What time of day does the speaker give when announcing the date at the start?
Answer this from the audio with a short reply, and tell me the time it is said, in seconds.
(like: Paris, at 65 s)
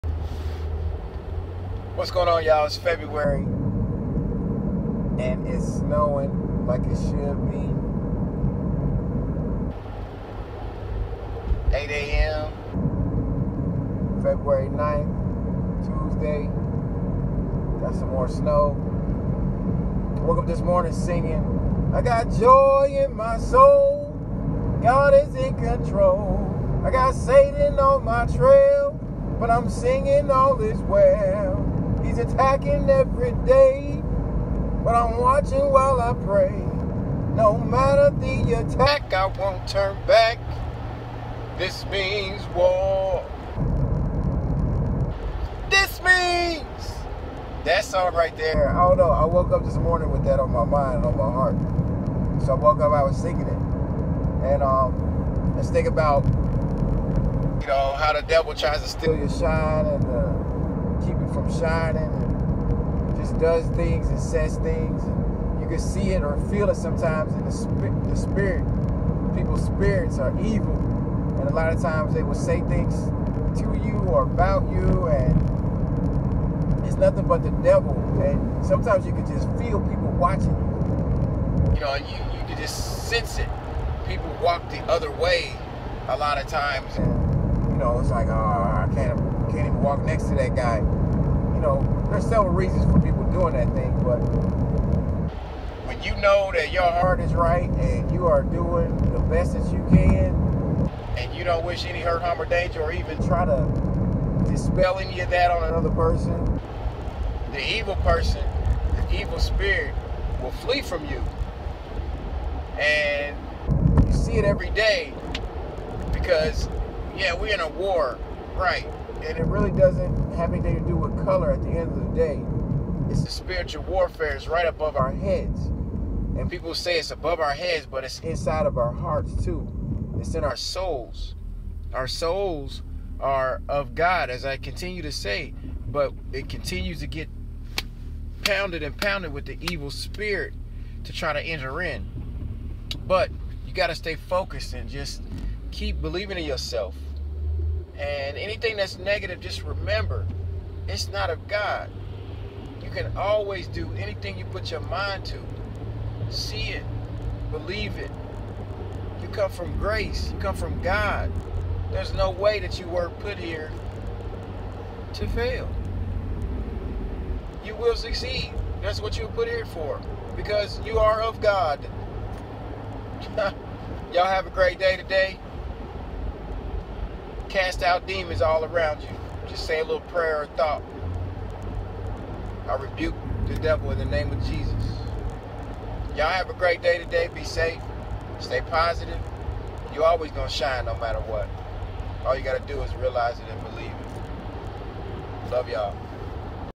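8 a.m., at 11 s.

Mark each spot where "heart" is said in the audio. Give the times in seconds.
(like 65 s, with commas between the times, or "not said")
51 s, 96 s, 128 s.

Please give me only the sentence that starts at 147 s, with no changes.
And anything that's negative, just remember, it's not of God.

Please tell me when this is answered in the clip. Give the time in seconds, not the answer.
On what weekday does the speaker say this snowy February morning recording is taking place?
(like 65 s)
15 s.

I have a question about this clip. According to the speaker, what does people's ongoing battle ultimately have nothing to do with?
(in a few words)
color.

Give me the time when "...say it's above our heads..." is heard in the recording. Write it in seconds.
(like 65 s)
126 s.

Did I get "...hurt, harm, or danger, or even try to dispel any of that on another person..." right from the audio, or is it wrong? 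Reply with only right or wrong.
right.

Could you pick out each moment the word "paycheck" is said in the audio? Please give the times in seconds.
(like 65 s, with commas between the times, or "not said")
not said.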